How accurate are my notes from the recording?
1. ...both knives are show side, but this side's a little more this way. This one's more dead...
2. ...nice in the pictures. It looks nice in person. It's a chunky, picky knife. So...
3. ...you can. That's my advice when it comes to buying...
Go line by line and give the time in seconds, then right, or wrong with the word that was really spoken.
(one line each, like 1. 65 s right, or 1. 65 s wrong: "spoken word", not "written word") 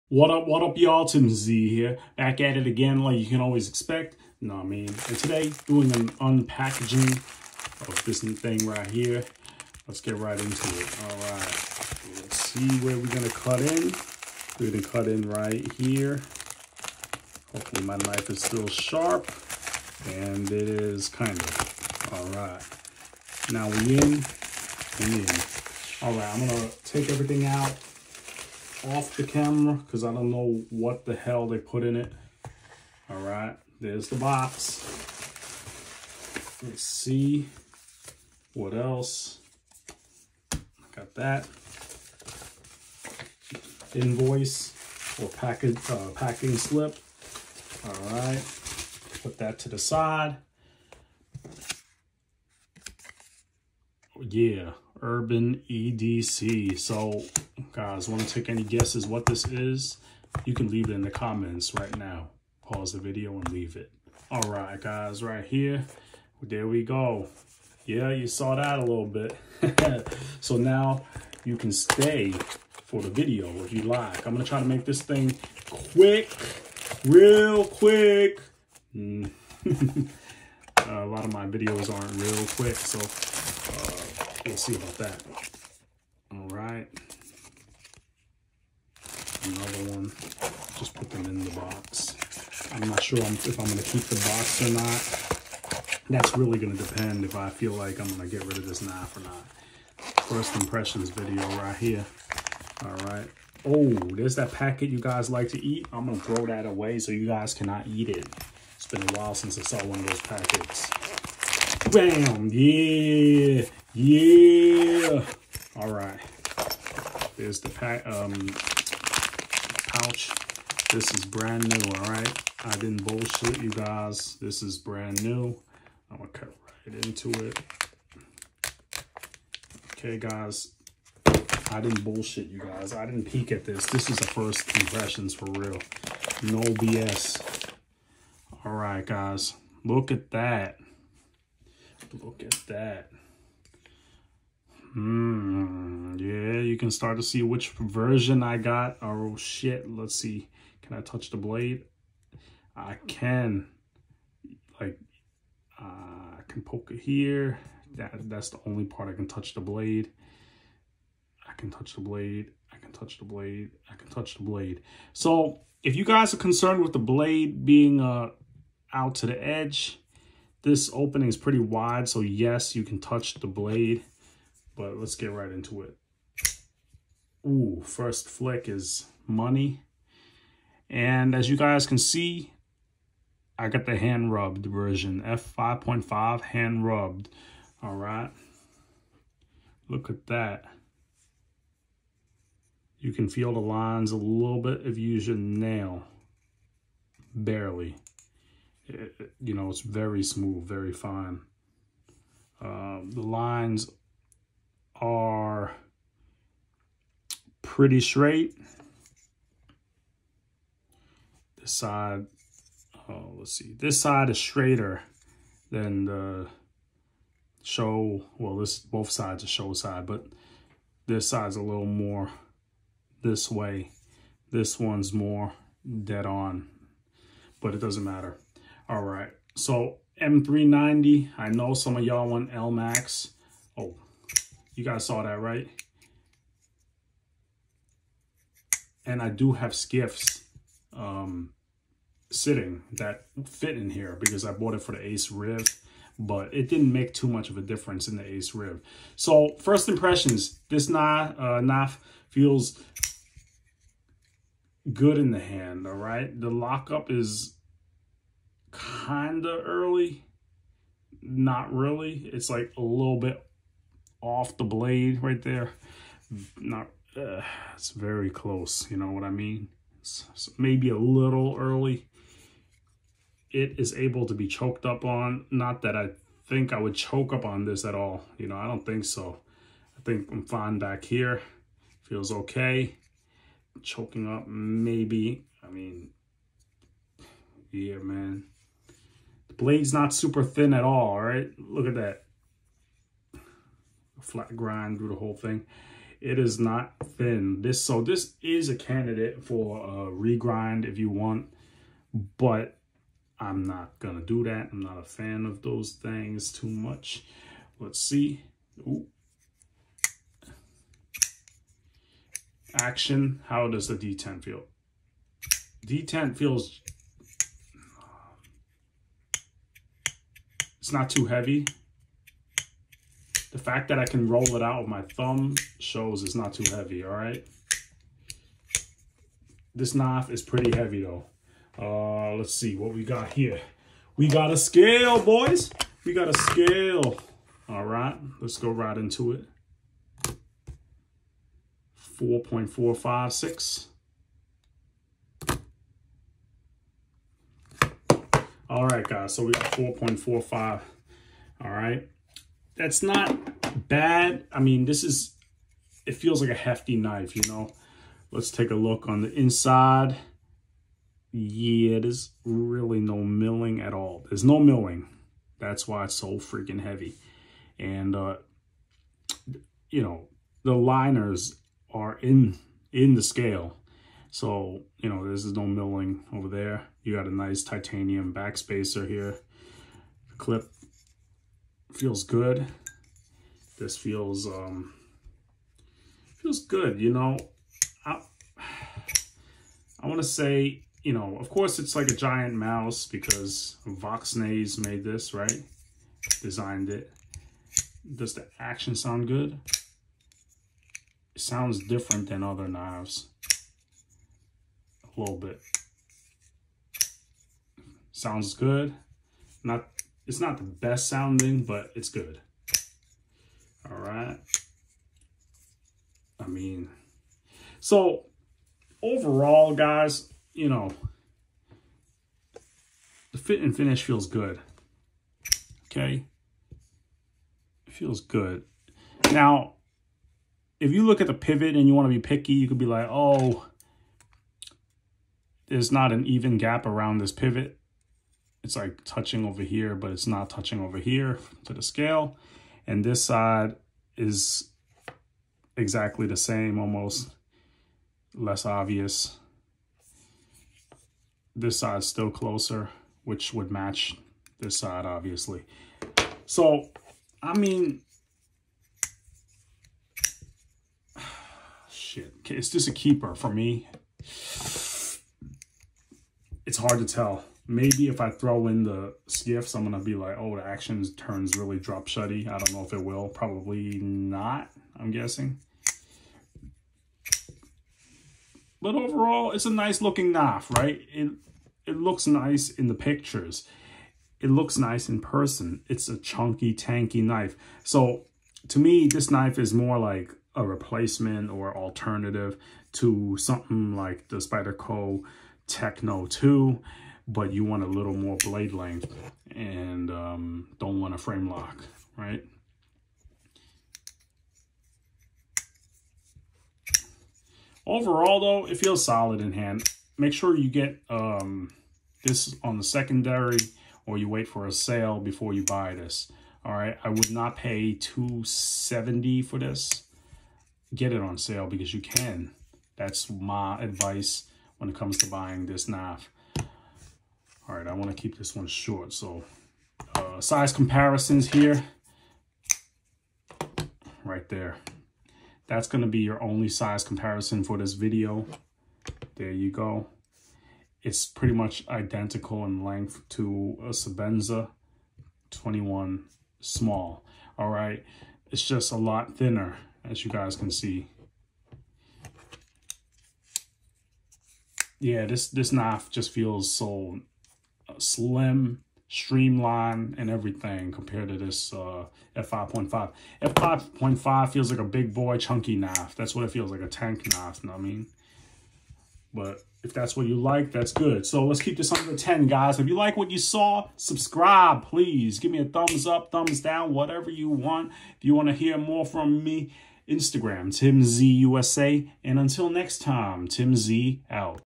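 1. 218 s wrong: "sides", not "knives"
2. 482 s wrong: "tanky", not "picky"
3. 521 s right.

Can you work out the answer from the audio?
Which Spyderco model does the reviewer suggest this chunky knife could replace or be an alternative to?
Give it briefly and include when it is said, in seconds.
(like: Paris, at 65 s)
Spyderco Techno 2, at 494 s.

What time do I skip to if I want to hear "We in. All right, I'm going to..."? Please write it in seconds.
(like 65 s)
24 s.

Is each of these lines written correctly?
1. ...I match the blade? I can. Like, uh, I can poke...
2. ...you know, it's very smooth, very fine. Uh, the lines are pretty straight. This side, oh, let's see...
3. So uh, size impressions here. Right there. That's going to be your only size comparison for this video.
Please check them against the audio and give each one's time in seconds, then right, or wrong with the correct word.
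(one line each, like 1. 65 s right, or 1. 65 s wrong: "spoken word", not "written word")
1. 150 s wrong: "touch", not "match"
2. 199 s right
3. 529 s wrong: "comparisons", not "impressions".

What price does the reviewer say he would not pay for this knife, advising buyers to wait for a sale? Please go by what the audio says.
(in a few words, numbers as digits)
270.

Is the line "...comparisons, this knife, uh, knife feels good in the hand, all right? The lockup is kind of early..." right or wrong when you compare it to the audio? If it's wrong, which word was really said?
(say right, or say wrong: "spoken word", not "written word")
wrong: "impressions", not "comparisons".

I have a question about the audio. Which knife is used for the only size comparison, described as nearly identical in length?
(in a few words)
Sebenza 21 small.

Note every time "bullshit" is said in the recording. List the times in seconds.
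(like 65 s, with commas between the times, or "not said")
123 s, 132 s.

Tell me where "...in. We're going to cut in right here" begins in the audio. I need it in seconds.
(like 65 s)
13 s.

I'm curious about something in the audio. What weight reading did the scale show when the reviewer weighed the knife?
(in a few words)
4.45.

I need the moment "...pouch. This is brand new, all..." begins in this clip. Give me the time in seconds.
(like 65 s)
119 s.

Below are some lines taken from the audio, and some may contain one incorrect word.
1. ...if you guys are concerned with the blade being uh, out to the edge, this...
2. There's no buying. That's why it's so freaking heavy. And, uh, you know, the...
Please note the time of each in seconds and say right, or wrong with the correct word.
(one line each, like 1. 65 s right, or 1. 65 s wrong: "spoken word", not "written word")
1. 165 s right
2. 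364 s wrong: "milling", not "buying".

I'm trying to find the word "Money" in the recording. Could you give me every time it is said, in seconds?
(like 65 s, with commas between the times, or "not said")
179 s.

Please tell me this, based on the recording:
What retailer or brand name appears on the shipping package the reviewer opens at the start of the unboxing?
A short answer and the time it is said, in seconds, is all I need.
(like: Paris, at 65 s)
Urban EDC, at 55 s.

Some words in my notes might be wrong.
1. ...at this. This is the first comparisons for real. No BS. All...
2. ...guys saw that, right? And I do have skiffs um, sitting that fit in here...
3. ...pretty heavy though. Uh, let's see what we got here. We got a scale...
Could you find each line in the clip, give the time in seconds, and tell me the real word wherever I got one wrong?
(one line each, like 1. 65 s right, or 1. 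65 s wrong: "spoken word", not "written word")
1. 133 s wrong: "impressions", not "comparisons"
2. 234 s right
3. 330 s right.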